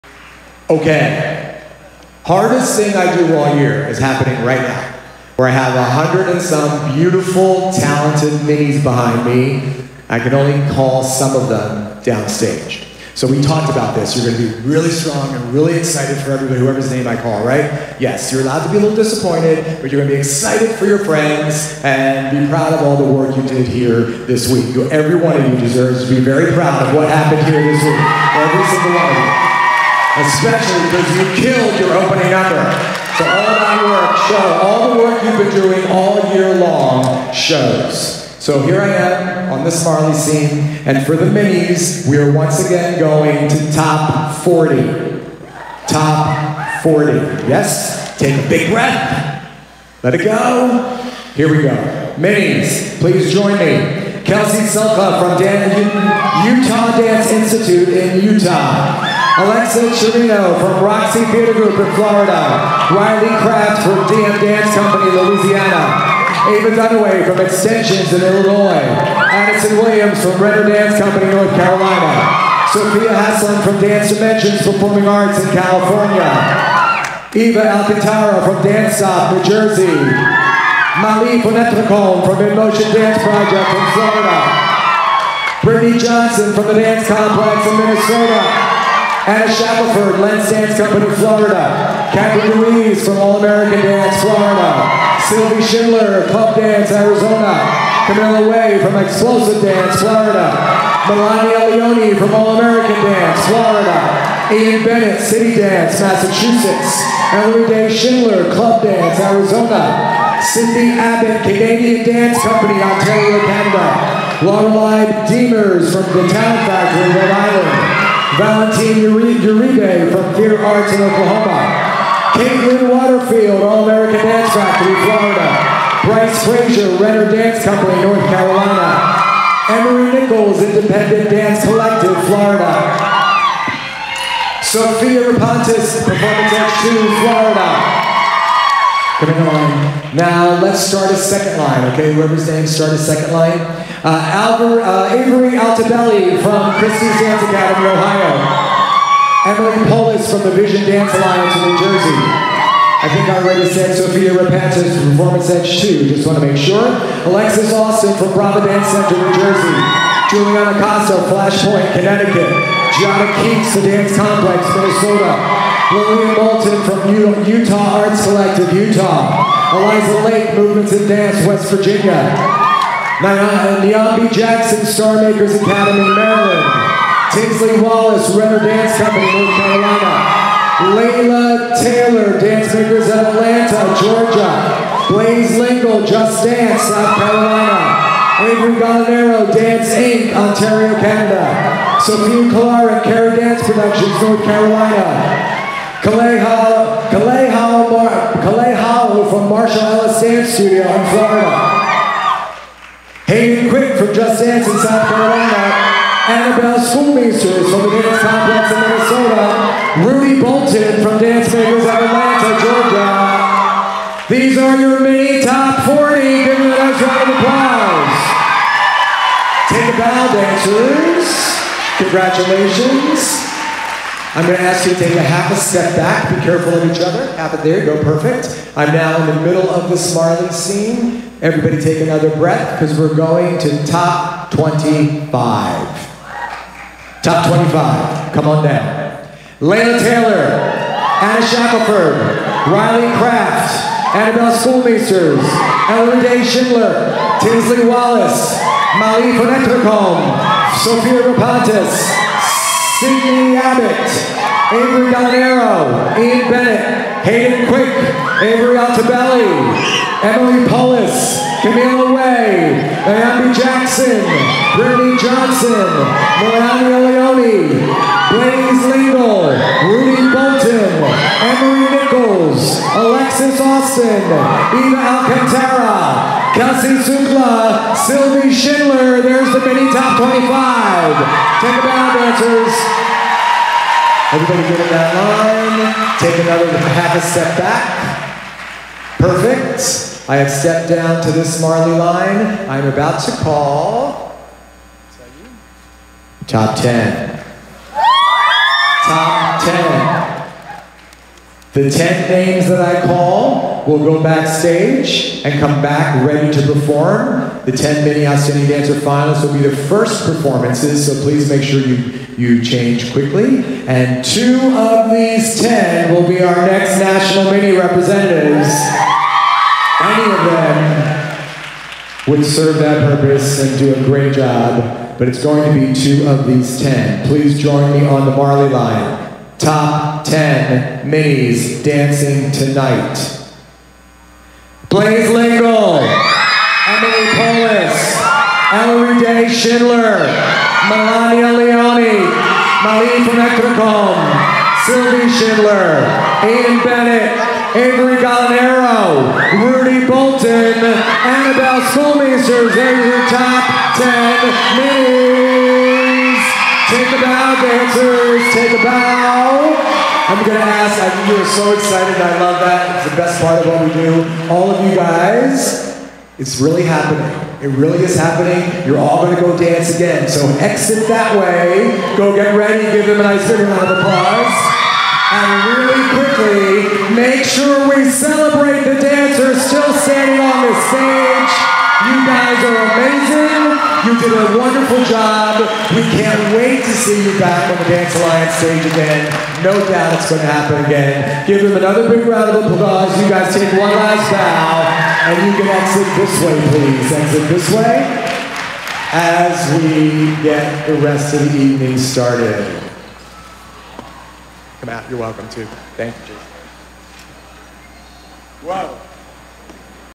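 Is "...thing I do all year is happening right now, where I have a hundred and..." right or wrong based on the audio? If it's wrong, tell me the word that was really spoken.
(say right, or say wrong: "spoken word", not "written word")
right.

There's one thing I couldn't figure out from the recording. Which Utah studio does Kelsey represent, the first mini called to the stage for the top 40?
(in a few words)
Dan Utah Dance Institute.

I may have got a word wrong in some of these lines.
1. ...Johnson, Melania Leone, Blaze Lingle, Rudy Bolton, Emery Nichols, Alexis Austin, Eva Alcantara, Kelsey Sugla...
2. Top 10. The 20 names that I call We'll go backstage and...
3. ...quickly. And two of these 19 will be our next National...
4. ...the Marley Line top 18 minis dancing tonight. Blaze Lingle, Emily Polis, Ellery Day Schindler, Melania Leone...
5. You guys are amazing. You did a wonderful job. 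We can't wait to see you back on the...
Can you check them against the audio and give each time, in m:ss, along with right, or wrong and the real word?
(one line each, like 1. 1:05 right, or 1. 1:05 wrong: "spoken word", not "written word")
1. 4:25 right
2. 4:59 wrong: "10", not "20"
3. 5:13 wrong: "10", not "19"
4. 5:28 wrong: "10", not "18"
5. 6:22 right.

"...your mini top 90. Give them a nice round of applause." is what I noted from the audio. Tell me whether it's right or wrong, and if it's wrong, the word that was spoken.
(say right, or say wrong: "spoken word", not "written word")
wrong: "40", not "90".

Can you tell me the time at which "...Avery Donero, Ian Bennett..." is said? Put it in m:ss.
4:14.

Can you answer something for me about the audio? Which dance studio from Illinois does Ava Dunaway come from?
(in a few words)
Extensions.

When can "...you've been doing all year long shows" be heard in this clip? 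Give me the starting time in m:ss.
0:35.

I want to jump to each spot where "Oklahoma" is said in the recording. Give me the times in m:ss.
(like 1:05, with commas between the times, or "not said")
2:01.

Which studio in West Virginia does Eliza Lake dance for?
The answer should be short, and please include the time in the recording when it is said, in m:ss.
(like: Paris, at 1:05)
Movements in Dance, at 2:50.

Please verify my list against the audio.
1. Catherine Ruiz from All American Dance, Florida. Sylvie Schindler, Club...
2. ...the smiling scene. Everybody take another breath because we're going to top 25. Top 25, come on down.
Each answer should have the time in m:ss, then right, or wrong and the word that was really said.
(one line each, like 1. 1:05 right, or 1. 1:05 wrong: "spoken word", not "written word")
1. 1:32 right
2. 3:49 right.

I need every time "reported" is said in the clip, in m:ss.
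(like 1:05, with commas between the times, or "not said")
not said.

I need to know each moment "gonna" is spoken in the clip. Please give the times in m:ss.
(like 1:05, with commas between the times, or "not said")
6:00, 6:09.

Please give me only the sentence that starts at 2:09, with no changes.
Emery Nichols, Independent Dance Collective, Florida.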